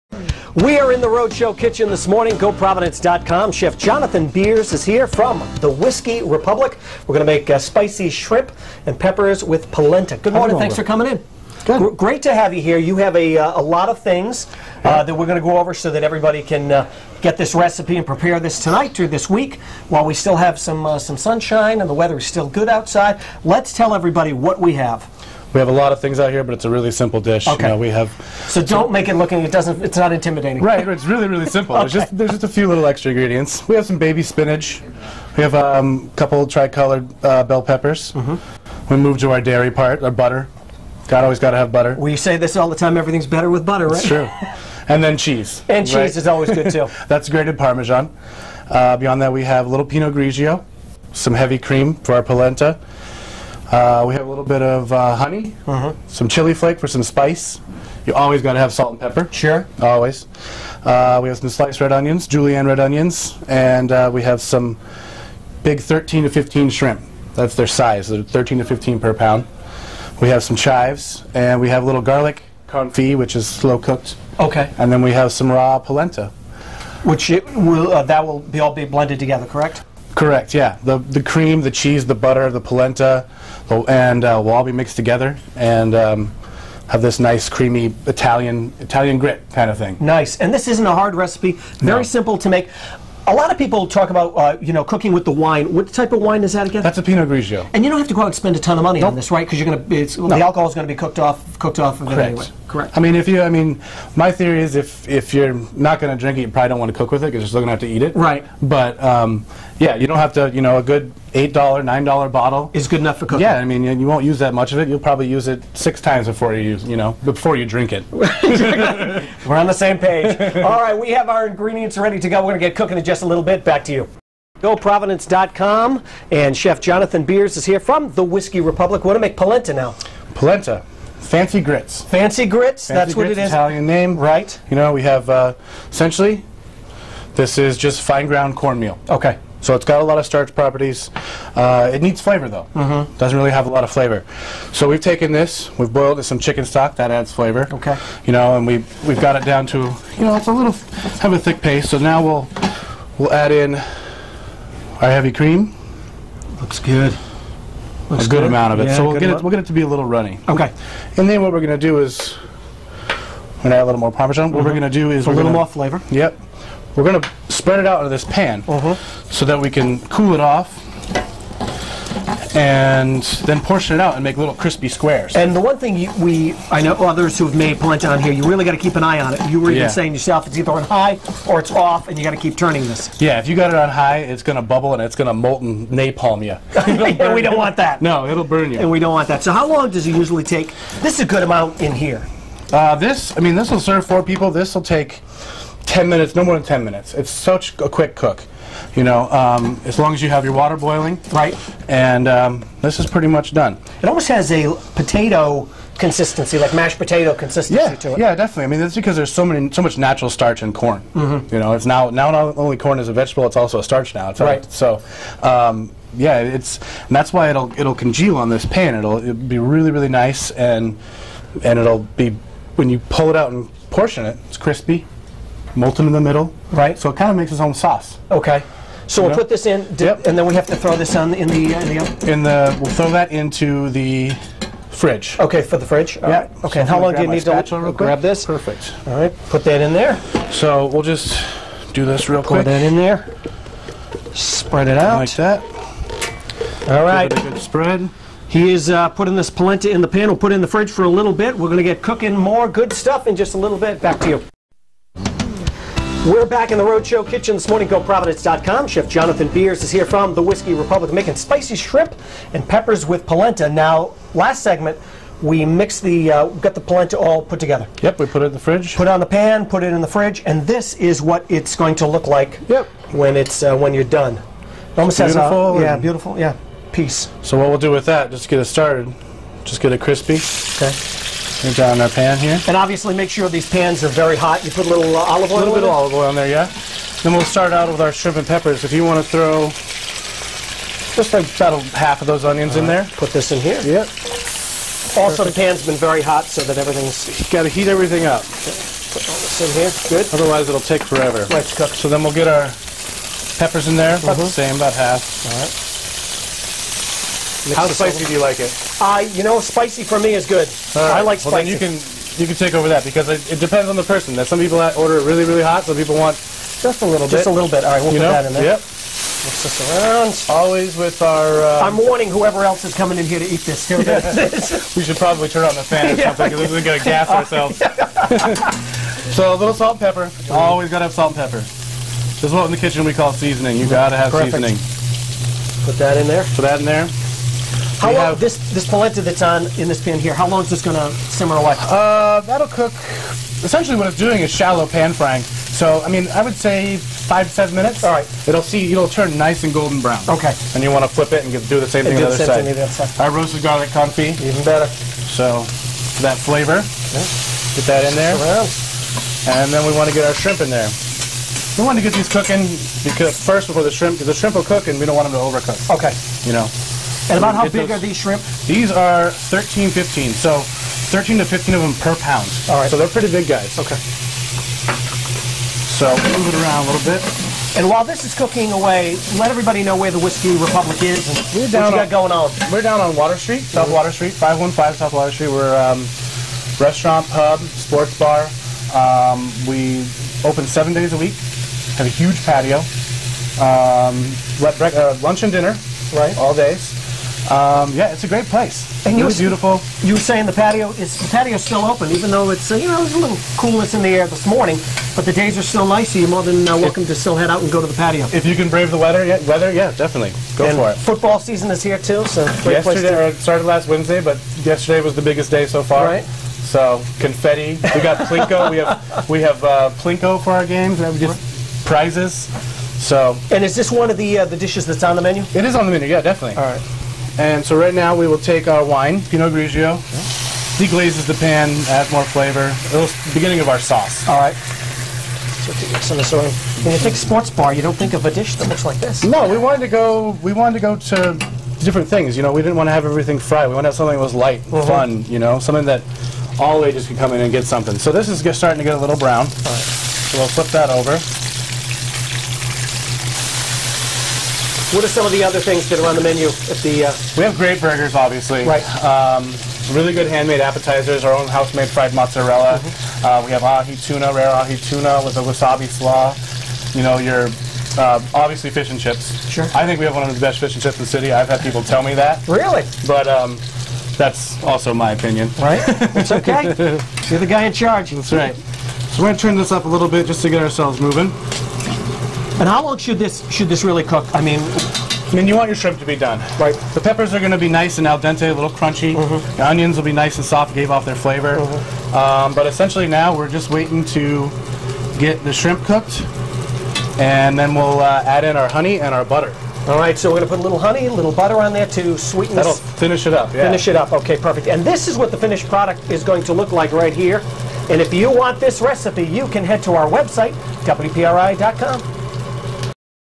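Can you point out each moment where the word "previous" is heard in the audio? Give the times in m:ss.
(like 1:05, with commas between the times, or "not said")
not said.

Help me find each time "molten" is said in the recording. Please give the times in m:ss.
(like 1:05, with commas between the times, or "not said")
3:05, 3:45.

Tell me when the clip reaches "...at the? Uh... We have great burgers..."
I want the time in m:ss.
7:36.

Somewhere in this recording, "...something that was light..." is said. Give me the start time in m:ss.
7:23.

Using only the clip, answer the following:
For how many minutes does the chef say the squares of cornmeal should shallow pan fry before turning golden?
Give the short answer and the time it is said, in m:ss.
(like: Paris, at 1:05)
5 to 7 minutes, at 5:46.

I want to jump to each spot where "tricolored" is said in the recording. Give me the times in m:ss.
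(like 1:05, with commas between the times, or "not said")
0:36.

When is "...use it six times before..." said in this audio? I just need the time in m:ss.
1:55.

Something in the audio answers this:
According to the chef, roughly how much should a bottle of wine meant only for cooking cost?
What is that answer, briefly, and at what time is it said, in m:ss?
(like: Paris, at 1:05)
8 or 9 dollars, at 1:51.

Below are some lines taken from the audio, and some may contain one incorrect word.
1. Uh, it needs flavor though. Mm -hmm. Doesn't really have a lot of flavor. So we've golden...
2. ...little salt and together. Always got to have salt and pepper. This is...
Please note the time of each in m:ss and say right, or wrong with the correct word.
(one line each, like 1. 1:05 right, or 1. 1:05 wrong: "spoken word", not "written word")
1. 2:21 wrong: "taken", not "golden"
2. 5:29 wrong: "pepper", not "together".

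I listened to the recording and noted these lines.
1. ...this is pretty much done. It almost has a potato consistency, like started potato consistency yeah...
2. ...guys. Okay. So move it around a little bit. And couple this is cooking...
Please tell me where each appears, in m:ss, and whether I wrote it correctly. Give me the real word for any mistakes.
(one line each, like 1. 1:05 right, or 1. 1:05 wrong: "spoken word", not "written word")
1. 3:22 wrong: "mashed", not "started"
2. 6:13 wrong: "while", not "couple".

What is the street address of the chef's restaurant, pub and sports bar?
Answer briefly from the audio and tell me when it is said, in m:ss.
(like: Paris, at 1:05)
515 South Water Street, at 6:24.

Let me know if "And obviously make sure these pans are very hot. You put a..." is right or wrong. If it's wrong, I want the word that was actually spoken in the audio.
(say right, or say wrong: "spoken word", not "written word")
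right.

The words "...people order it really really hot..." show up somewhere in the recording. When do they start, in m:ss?
5:14.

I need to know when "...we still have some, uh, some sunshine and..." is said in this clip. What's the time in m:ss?
0:20.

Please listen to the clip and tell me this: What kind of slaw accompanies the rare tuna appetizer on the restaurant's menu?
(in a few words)
Wasabi slaw.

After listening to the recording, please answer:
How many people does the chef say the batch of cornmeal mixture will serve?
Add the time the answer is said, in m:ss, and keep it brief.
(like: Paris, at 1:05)
4, at 3:14.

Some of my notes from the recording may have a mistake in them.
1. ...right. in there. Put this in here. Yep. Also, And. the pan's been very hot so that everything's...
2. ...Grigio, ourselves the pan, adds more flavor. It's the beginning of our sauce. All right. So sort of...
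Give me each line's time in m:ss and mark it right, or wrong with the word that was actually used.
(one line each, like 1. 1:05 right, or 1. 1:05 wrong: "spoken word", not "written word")
1. 4:52 wrong: "Perfect", not "And"
2. 7:09 wrong: "deglazes", not "ourselves".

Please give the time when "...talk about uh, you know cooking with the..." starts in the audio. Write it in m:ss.
1:33.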